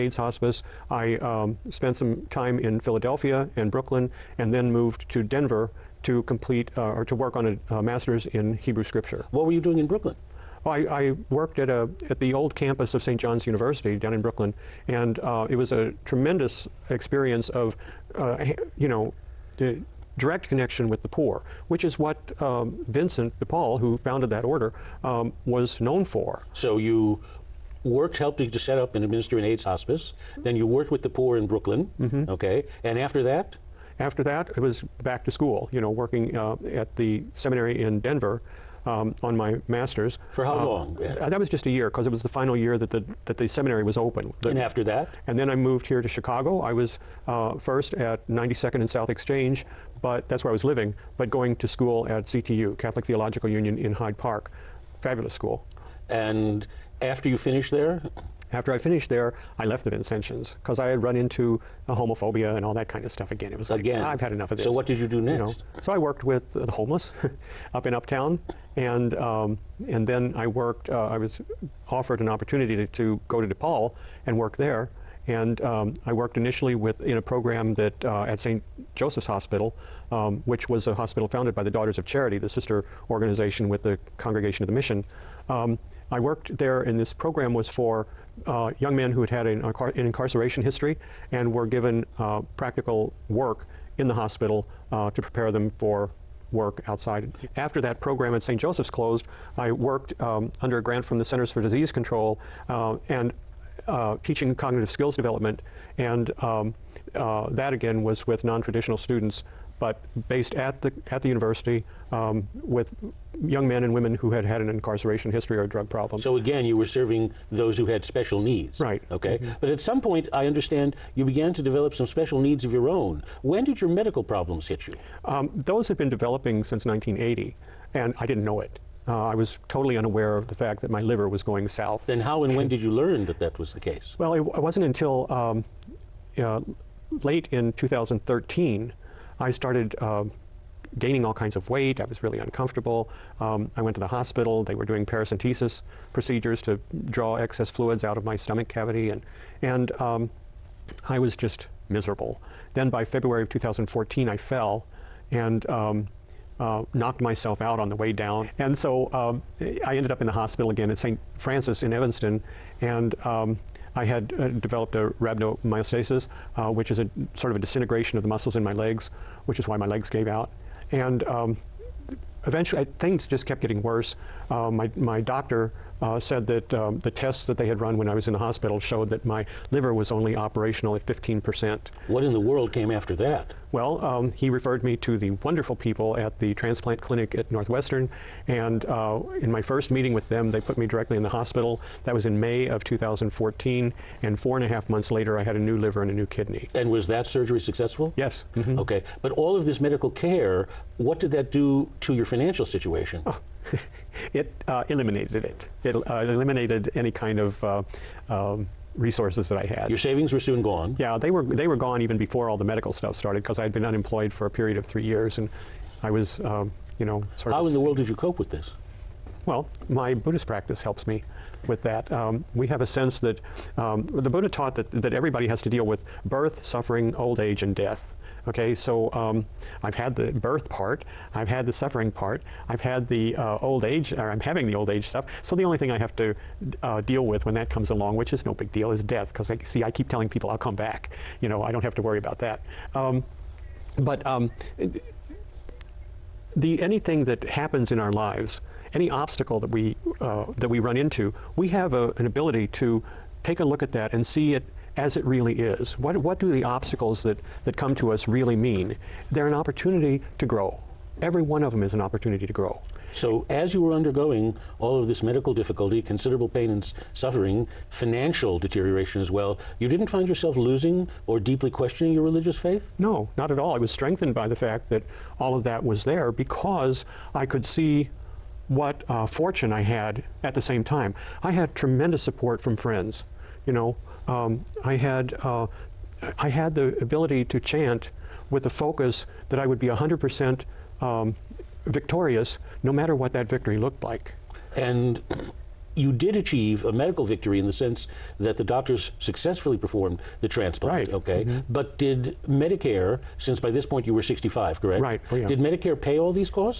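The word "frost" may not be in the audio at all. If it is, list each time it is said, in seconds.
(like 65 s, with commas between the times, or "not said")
not said.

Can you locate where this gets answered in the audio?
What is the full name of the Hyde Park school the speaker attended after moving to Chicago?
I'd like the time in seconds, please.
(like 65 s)
52 s.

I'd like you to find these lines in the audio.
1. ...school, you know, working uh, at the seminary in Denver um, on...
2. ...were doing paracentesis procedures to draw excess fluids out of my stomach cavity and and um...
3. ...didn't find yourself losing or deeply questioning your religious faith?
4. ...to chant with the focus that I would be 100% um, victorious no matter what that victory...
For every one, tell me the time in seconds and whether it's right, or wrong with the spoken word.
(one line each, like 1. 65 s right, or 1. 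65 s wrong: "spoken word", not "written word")
1. 35 s right
2. 144 s right
3. 269 s right
4. 287 s right.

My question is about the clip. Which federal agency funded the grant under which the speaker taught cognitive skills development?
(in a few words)
Centers for Disease Control.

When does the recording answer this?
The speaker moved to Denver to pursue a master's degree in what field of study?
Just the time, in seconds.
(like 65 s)
8 s.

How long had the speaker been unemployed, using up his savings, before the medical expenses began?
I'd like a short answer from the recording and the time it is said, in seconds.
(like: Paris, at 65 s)
3 years, at 214 s.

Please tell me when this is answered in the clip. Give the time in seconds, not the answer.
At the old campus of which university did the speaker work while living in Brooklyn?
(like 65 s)
13 s.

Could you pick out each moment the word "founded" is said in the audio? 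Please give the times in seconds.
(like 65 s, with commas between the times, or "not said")
23 s, 81 s.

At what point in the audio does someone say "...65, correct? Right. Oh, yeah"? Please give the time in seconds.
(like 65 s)
304 s.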